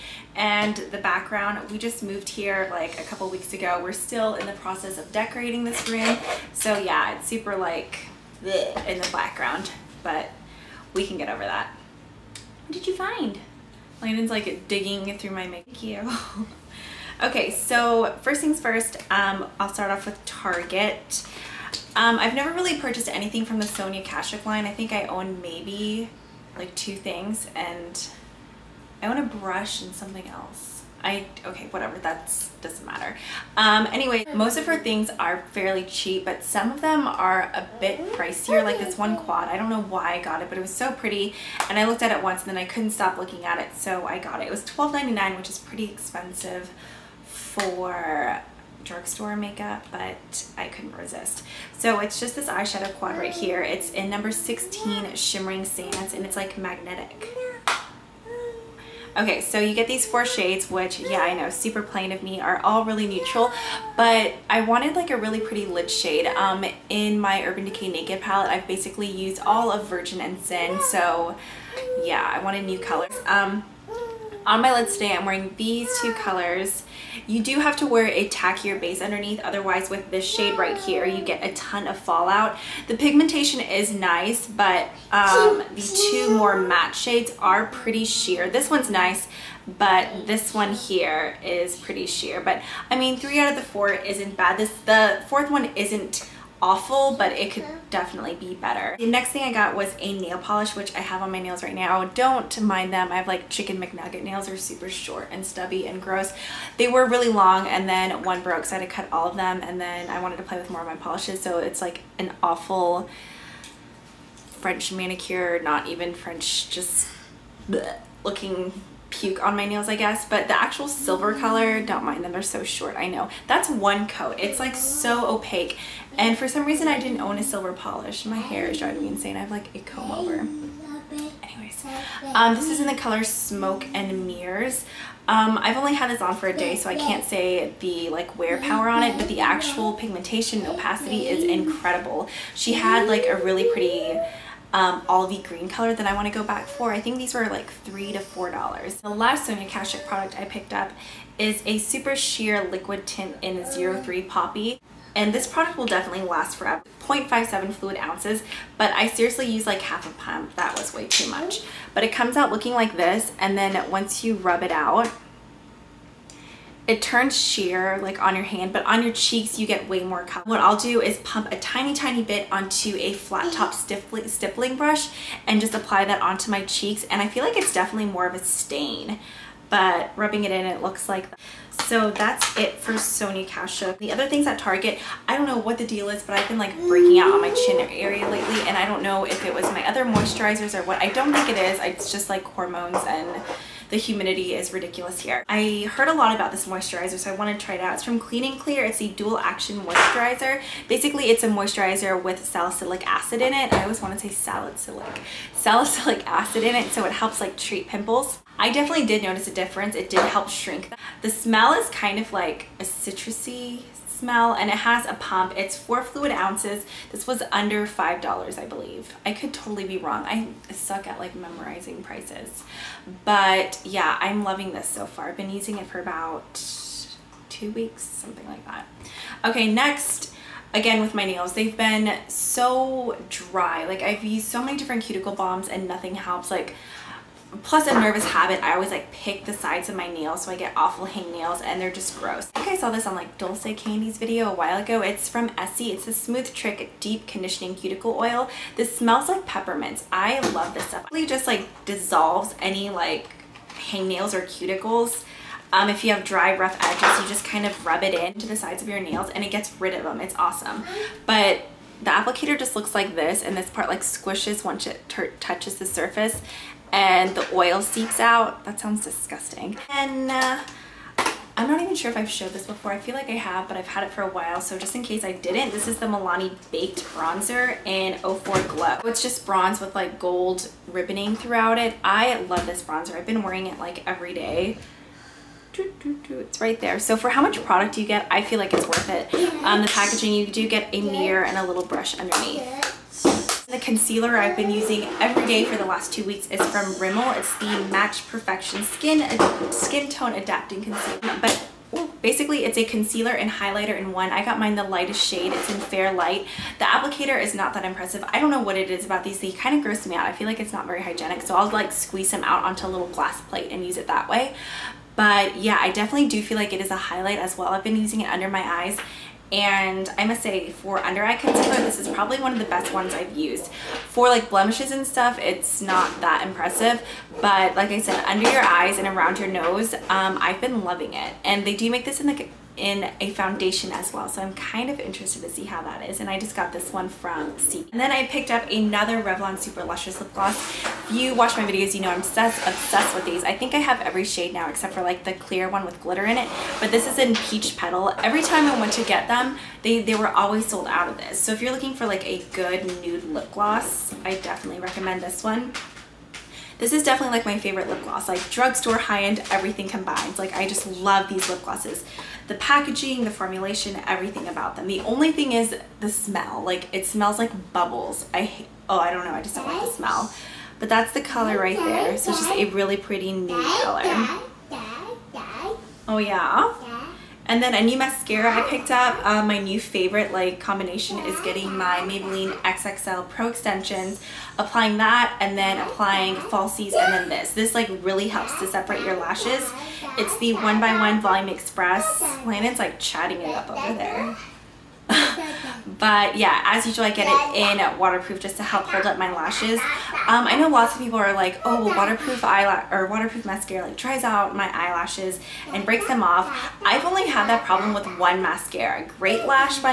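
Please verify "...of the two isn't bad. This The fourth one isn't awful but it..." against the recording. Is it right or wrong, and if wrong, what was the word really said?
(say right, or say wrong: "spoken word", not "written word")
wrong: "four", not "two".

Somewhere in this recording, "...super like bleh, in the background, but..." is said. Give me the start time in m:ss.
0:07.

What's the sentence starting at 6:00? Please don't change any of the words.
Like I just love these lip glosses the packaging, the formulation, everything about them.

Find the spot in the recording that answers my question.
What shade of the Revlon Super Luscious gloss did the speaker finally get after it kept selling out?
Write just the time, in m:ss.
5:47.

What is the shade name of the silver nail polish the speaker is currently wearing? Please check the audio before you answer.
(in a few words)
Smoke and Mirrors.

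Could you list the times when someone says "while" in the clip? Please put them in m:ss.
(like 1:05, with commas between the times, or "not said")
4:04, 4:34.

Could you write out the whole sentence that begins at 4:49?
Um, the packaging, you do get a mirror and a little brush underneath.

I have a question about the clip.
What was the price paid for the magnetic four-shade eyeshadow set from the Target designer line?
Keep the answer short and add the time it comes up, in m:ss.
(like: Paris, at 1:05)
$12.99, at 0:44.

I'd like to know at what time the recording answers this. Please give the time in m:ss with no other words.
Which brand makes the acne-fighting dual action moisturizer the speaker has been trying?
3:18.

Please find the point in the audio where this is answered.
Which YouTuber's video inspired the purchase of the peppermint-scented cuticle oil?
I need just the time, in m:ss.
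4:03.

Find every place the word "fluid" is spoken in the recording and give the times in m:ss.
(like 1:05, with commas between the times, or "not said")
2:37, 3:36.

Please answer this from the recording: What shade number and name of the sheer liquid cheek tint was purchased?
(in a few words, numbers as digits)
03 Poppy.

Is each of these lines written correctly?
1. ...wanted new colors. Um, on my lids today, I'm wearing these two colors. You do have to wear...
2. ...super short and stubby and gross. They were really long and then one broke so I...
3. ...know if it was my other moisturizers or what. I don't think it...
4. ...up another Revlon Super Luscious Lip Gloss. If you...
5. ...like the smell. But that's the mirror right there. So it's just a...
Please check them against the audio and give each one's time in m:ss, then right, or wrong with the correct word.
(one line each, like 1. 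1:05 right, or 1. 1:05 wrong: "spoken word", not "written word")
1. 1:12 right
2. 1:44 right
3. 3:09 right
4. 5:38 right
5. 6:09 wrong: "color", not "mirror".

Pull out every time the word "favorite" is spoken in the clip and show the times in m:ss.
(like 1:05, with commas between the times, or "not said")
5:57, 6:19.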